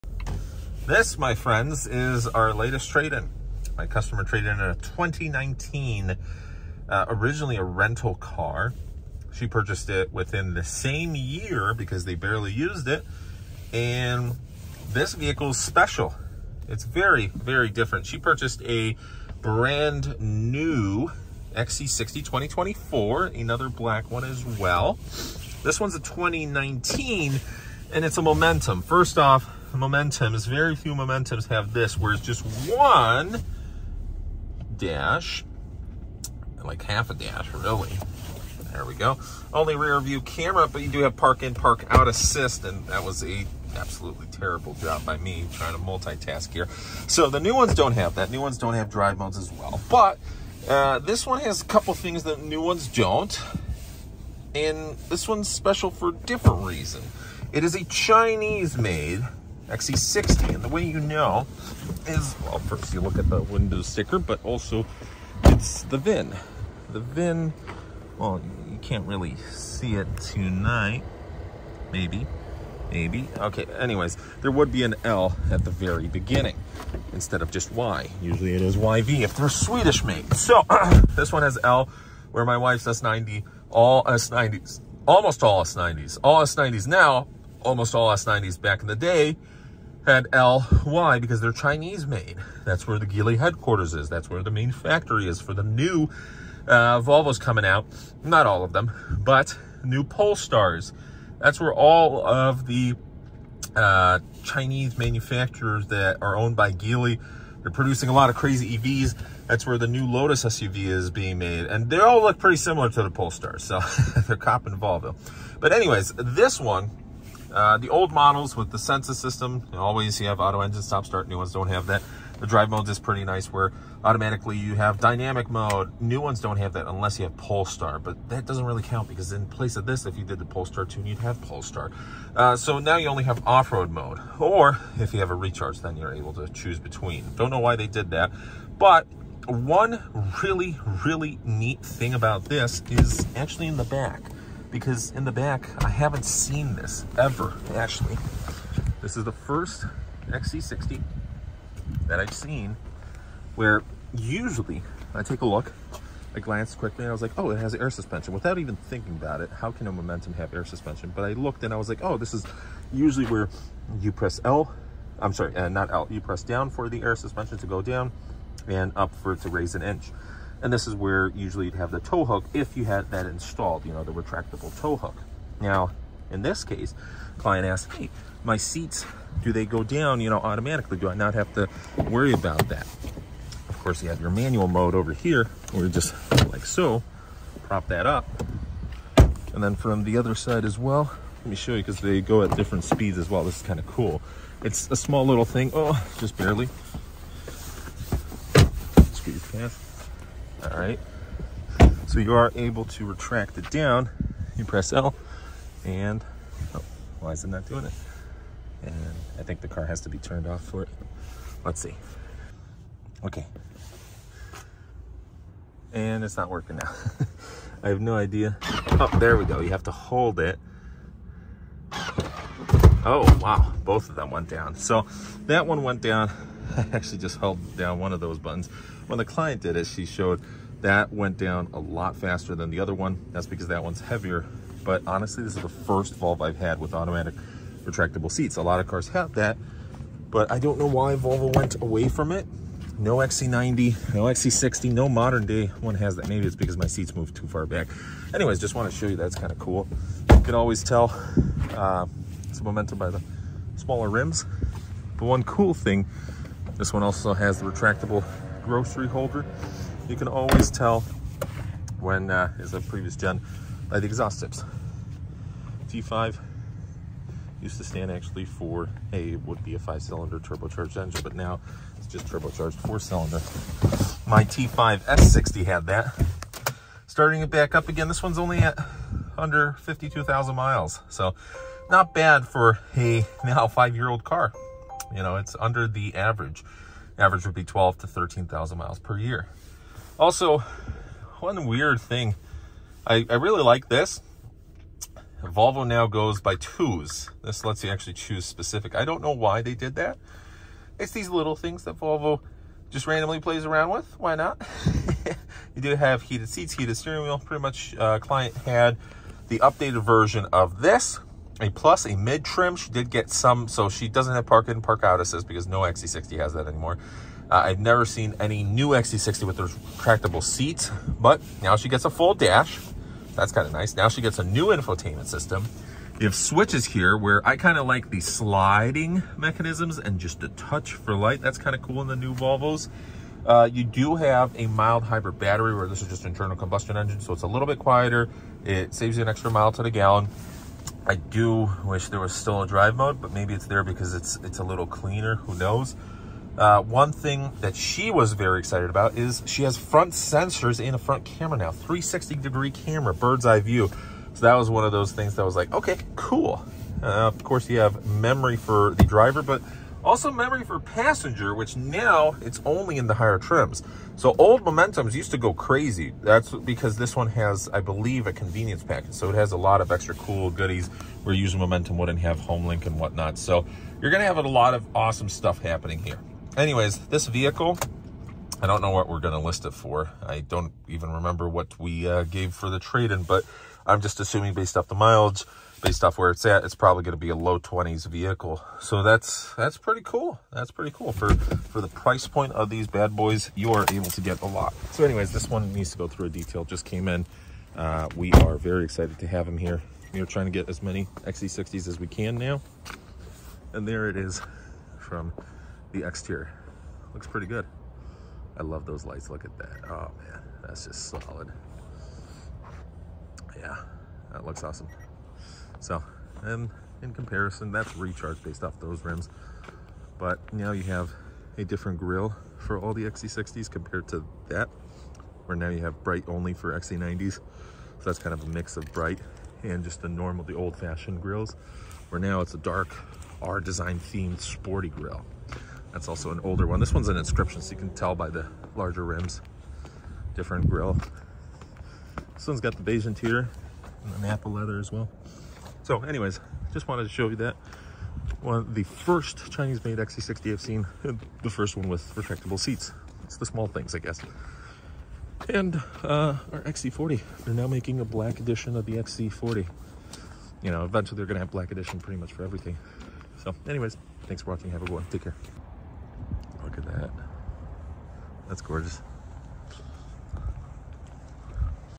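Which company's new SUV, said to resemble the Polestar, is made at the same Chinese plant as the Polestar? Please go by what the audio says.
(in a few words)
Lotus.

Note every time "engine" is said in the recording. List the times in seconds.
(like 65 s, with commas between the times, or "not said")
120 s, 270 s, 336 s.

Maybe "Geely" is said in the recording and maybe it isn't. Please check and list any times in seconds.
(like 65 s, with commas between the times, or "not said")
93 s, 106 s.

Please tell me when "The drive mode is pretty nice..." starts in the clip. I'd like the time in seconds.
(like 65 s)
122 s.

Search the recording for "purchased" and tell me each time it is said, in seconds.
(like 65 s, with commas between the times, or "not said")
9 s, 18 s.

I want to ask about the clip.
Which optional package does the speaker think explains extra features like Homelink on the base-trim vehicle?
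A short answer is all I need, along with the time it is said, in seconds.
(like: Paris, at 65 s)
convenience package, at 368 s.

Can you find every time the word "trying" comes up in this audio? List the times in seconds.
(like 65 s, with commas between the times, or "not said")
45 s, 400 s.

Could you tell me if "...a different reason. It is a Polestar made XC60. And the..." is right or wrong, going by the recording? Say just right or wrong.
wrong.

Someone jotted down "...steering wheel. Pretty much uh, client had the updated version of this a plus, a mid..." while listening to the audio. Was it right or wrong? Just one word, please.
right.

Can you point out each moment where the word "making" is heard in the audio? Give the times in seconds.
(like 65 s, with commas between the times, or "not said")
457 s.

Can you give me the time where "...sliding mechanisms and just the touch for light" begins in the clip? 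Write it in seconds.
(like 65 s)
328 s.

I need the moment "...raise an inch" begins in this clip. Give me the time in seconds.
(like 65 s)
169 s.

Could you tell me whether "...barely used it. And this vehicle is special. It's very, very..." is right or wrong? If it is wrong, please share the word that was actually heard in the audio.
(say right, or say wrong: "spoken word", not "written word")
right.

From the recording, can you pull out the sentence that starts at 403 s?
And there it is from the exterior.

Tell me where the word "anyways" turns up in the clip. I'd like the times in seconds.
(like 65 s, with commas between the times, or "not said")
73 s, 115 s, 248 s, 376 s, 395 s, 446 s, 463 s.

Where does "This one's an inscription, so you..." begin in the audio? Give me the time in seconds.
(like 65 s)
436 s.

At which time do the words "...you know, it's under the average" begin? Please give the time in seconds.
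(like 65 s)
285 s.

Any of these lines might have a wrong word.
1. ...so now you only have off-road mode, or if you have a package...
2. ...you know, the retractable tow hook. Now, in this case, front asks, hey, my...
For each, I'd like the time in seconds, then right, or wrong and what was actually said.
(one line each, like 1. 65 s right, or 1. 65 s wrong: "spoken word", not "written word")
1. 132 s wrong: "recharge", not "package"
2. 173 s wrong: "client", not "front".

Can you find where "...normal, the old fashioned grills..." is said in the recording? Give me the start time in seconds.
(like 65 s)
430 s.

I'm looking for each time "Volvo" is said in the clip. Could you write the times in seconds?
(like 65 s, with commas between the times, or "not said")
97 s, 114 s, 236 s, 241 s, 295 s, 301 s, 332 s.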